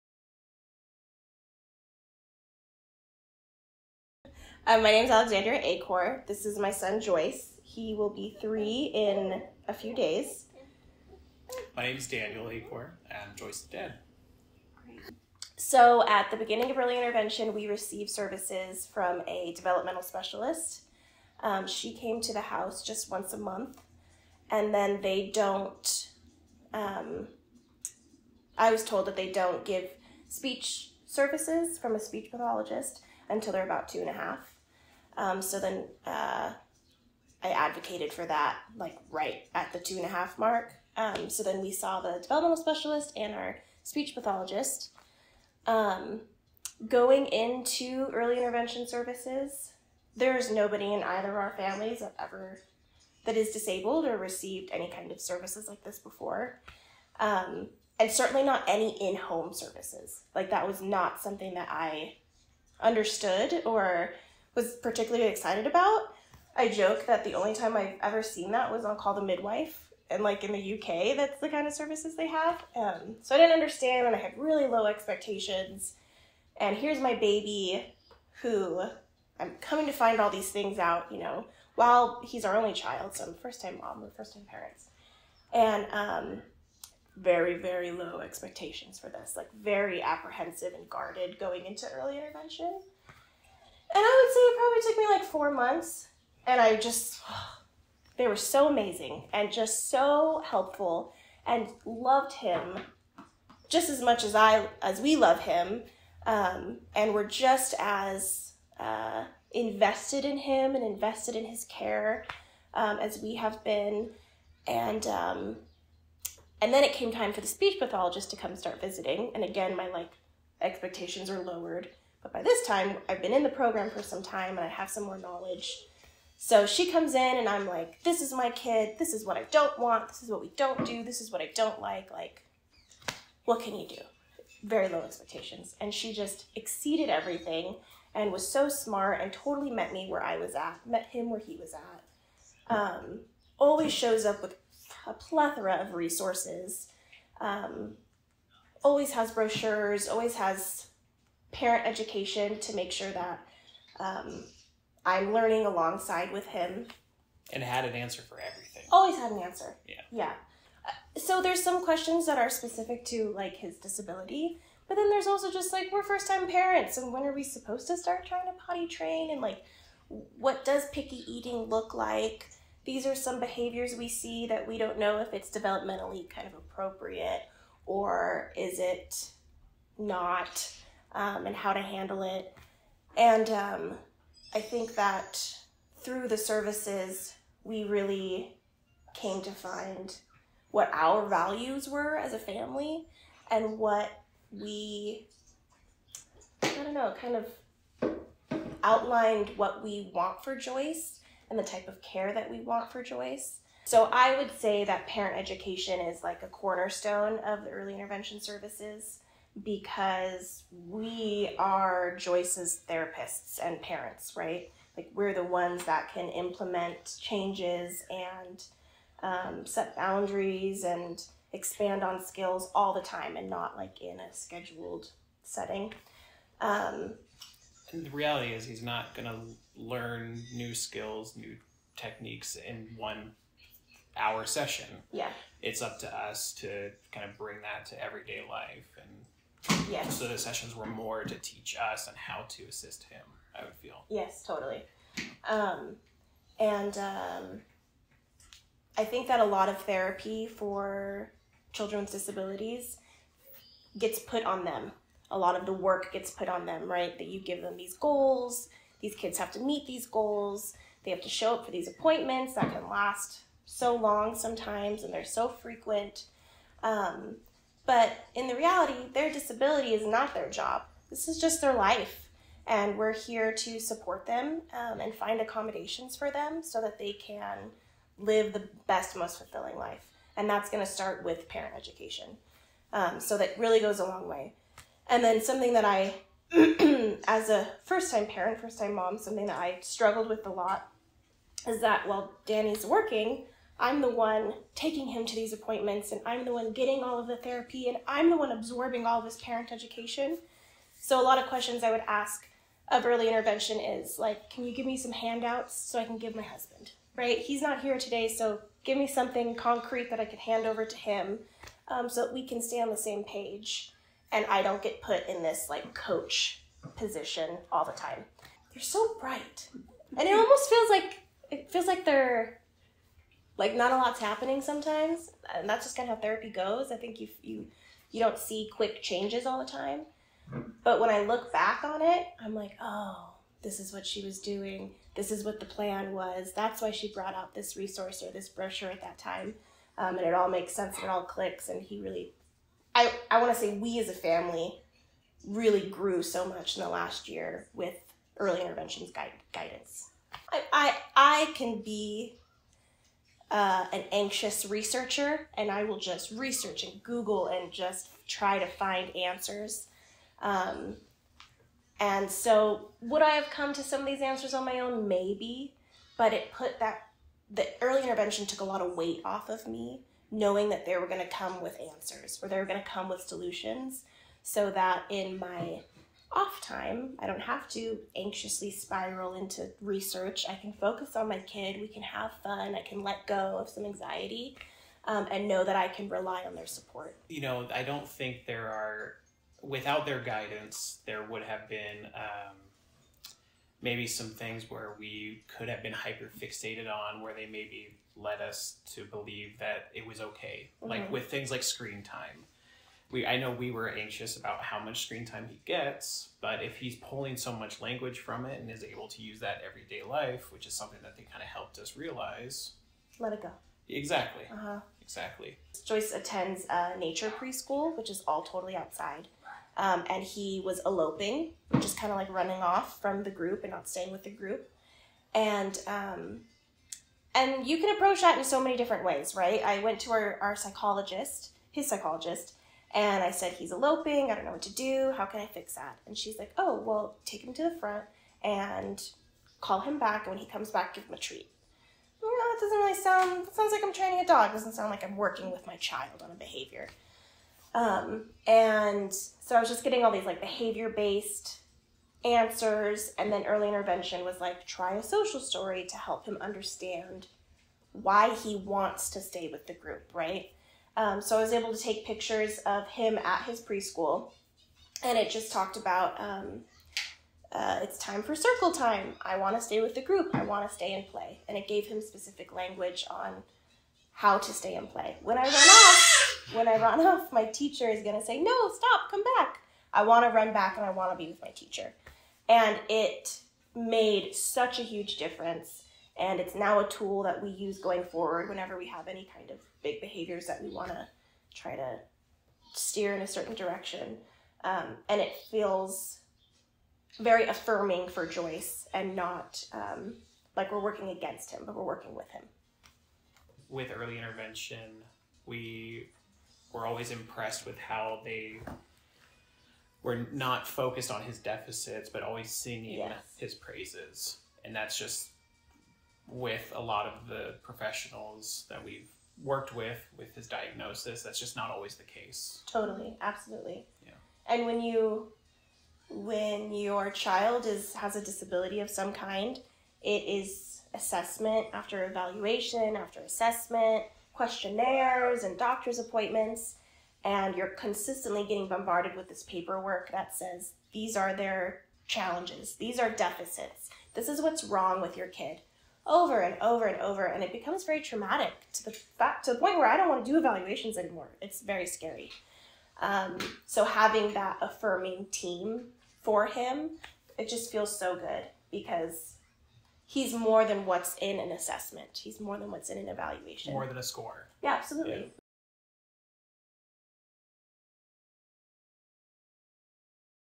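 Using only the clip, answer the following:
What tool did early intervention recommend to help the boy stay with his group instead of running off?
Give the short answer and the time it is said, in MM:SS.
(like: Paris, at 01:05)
Social story, at 07:35.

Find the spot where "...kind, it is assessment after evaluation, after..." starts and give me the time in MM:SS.
08:49.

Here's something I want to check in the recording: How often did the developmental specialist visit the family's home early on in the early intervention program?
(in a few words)
Once a month.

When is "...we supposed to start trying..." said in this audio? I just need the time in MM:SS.
02:47.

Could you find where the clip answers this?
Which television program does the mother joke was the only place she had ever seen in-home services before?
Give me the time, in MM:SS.
01:08.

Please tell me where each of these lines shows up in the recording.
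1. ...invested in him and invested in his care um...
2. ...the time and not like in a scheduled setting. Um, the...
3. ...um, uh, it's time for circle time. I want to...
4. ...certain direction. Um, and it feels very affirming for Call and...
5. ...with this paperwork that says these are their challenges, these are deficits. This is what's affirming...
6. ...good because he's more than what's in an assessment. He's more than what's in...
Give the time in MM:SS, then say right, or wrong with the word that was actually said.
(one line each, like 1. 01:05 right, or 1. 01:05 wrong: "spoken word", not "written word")
1. 01:49 right
2. 03:42 right
3. 07:46 right
4. 08:13 wrong: "Joyce", not "Call"
5. 08:59 wrong: "wrong", not "affirming"
6. 09:18 right.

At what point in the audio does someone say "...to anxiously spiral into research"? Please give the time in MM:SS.
06:17.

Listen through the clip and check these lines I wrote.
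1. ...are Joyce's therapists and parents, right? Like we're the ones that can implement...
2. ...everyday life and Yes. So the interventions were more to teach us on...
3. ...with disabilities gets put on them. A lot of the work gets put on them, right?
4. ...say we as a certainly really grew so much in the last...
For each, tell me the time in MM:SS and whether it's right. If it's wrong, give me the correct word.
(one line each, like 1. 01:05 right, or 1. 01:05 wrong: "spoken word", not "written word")
1. 03:31 right
2. 03:58 wrong: "sessions", not "interventions"
3. 04:12 right
4. 05:43 wrong: "family", not "certainly".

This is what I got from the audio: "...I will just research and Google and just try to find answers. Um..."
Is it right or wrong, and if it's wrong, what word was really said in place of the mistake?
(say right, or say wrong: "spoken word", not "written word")
right.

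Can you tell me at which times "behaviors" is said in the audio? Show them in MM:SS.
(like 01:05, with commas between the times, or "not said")
02:53, 07:26, 07:30, 08:10.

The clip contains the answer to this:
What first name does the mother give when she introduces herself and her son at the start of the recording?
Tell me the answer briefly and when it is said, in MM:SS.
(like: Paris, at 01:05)
Alexandra, at 00:05.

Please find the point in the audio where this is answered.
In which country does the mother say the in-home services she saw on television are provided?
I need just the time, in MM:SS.
01:10.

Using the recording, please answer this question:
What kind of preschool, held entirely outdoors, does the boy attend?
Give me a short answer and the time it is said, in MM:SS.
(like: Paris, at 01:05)
Nature preschool, at 06:56.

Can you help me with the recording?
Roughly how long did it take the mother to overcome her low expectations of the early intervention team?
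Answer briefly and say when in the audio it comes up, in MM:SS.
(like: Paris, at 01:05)
4 months, at 01:35.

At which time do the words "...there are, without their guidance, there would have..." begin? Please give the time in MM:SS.
06:28.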